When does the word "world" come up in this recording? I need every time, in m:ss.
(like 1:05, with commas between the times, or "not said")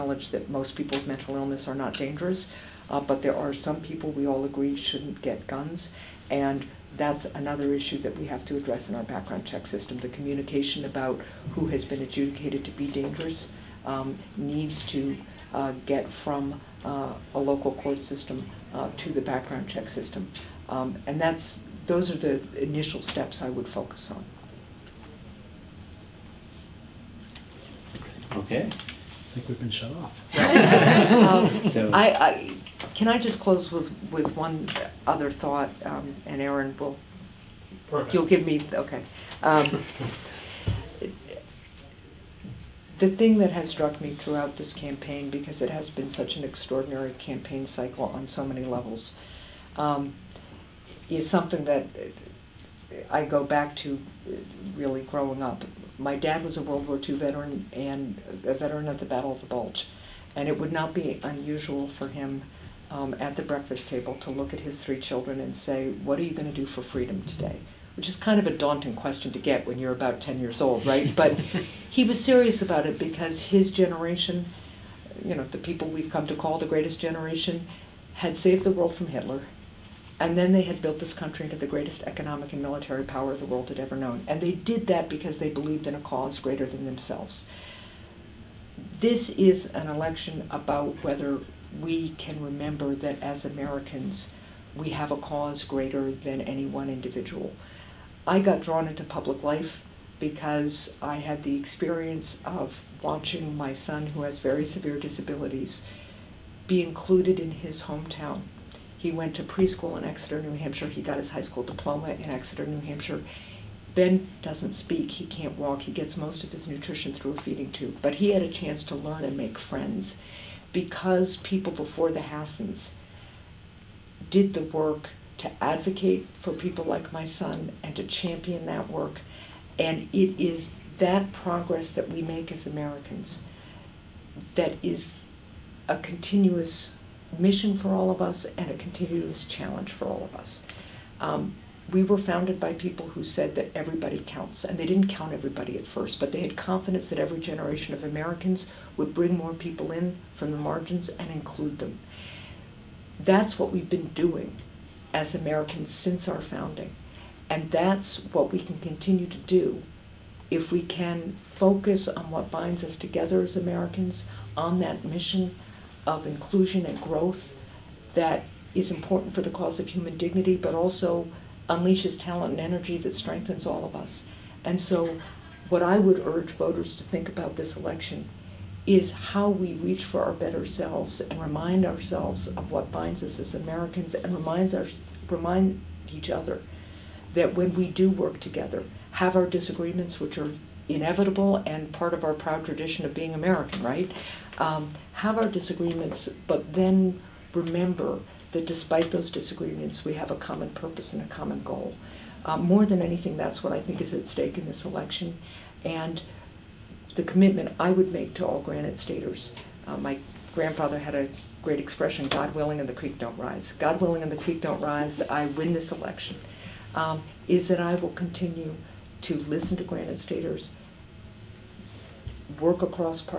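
0:56, 1:18, 1:23.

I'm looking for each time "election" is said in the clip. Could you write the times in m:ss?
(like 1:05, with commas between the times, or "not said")
1:29, 2:57, 3:24, 3:35.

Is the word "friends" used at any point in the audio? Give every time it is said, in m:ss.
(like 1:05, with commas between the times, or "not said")
1:59.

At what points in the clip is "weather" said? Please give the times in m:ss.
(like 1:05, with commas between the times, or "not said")
not said.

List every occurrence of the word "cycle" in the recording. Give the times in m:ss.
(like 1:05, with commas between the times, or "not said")
0:47.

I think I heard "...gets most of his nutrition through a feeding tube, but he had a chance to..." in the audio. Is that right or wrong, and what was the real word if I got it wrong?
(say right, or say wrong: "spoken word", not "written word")
right.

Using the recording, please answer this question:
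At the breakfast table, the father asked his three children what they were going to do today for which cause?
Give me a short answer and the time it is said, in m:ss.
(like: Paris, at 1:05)
freedom, at 1:06.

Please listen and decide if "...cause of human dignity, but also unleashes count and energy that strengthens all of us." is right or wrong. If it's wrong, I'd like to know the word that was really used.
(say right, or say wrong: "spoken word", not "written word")
wrong: "talent", not "count".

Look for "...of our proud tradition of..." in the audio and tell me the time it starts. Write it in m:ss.
3:12.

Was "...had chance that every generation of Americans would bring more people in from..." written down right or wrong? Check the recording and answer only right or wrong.
wrong.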